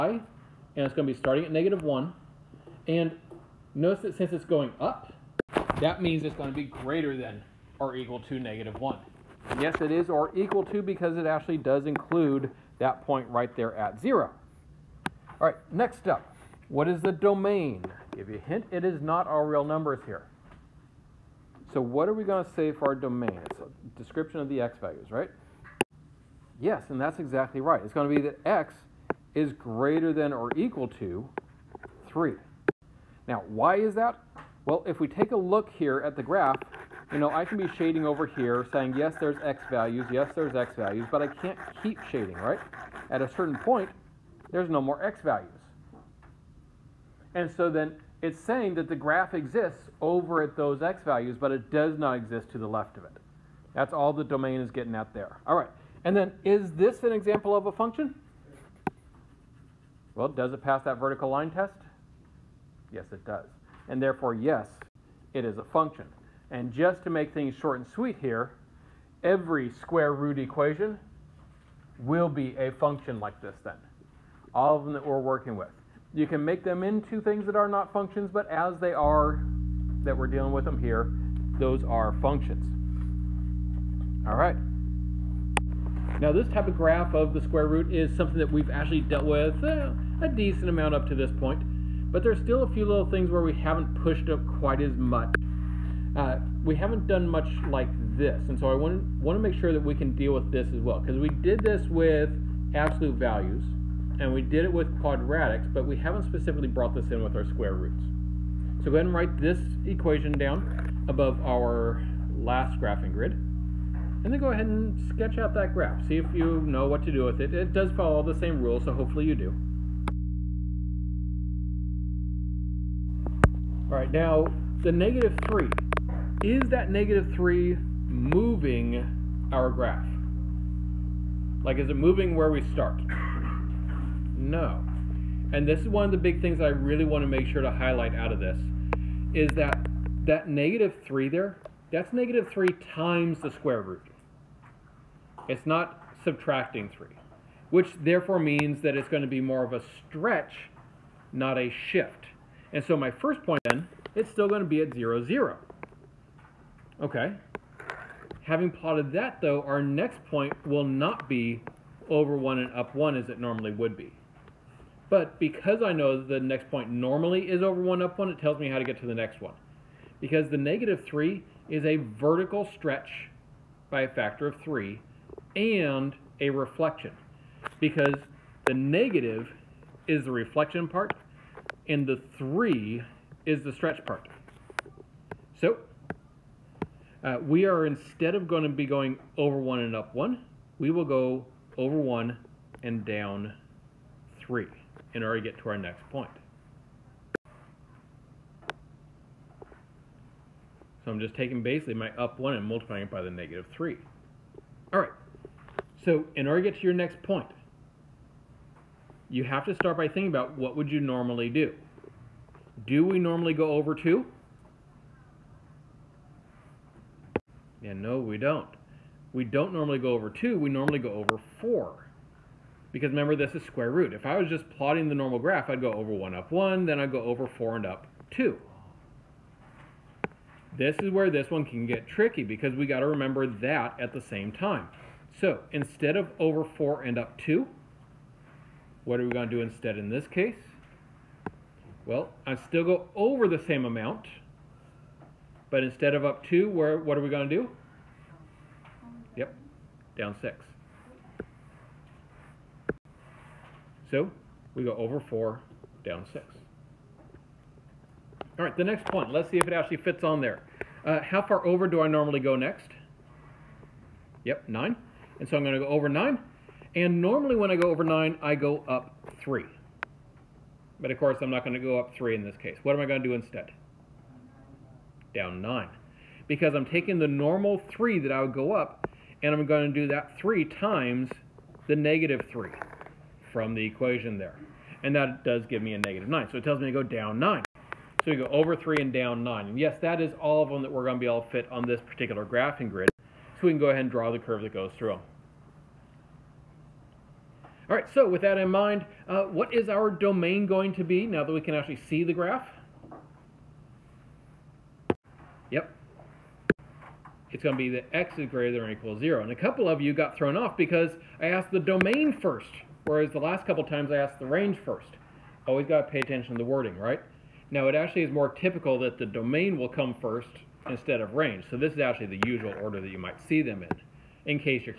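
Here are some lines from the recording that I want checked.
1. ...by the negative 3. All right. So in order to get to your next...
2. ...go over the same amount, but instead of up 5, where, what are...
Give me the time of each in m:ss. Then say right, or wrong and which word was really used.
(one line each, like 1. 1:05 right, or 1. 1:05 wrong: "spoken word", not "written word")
1. 3:23 right
2. 4:02 wrong: "2", not "5".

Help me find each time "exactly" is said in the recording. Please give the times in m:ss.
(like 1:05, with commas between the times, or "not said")
0:27.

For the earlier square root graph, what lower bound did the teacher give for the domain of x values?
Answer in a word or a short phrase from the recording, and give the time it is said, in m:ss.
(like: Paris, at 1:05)
x ≥ 3, at 0:30.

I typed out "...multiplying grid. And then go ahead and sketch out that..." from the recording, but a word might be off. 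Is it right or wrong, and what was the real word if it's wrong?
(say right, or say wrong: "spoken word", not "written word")
wrong: "graphing", not "multiplying".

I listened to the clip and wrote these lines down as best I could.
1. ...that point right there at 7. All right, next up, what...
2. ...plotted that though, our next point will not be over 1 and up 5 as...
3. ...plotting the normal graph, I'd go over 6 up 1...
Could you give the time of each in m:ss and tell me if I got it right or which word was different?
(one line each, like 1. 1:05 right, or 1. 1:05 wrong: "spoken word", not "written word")
1. 0:12 wrong: "0", not "7"
2. 2:38 wrong: "1", not "5"
3. 3:44 wrong: "1", not "6".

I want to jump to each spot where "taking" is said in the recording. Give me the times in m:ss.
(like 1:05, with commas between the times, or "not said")
3:21, 4:36.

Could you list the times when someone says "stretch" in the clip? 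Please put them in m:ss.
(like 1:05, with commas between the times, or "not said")
2:30, 2:52, 3:03.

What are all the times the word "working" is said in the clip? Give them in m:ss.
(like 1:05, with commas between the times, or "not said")
1:15.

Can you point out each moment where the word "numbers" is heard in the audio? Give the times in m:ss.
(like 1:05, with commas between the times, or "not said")
0:19.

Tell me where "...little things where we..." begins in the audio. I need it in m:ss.
1:32.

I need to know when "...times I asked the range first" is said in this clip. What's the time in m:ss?
5:13.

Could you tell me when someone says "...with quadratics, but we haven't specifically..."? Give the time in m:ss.
1:44.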